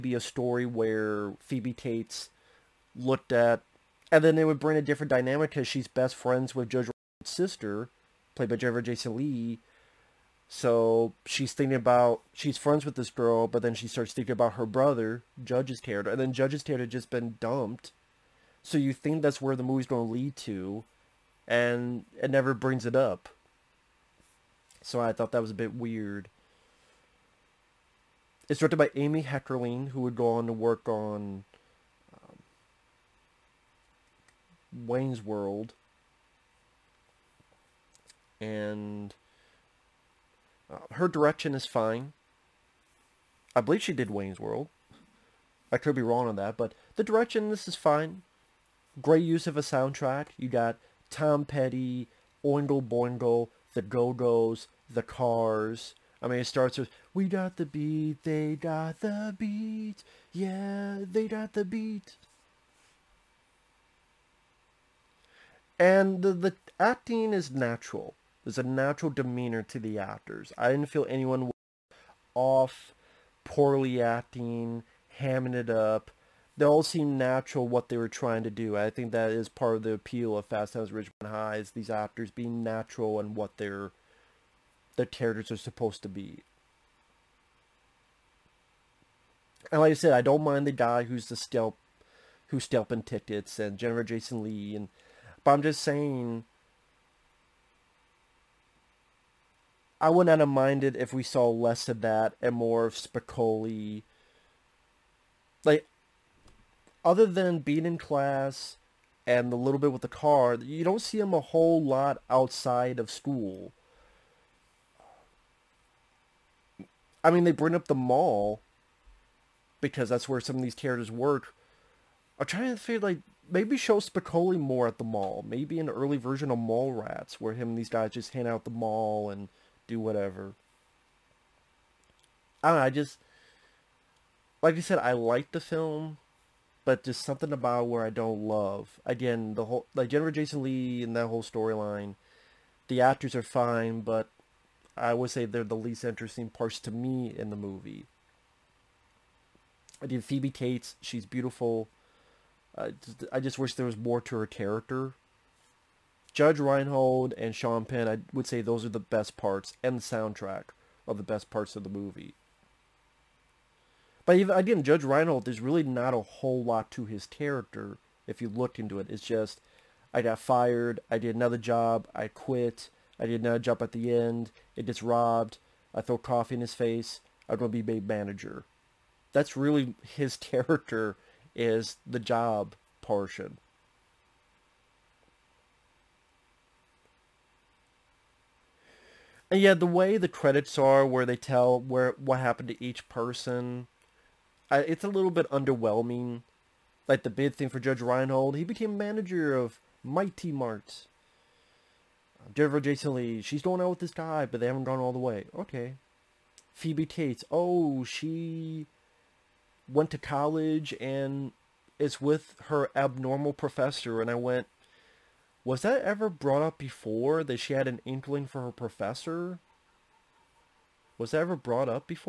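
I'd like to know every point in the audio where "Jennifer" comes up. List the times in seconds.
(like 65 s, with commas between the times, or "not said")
8 s, 93 s, 140 s, 202 s.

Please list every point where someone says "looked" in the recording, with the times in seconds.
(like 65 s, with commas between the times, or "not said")
2 s, 168 s.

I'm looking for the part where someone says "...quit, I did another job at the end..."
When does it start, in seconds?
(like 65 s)
172 s.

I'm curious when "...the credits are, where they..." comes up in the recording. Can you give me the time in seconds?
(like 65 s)
190 s.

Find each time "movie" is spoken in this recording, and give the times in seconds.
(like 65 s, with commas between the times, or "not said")
19 s, 147 s, 161 s.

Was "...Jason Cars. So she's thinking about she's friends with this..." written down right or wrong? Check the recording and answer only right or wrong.
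wrong.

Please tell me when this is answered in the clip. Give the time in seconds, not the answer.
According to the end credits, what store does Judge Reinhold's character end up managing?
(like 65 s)
200 s.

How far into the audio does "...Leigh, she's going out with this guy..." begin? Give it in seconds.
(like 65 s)
203 s.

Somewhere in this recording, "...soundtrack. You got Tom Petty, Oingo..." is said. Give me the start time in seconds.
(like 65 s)
49 s.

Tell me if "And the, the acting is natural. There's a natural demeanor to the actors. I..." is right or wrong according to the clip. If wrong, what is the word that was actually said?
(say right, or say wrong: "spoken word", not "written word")
right.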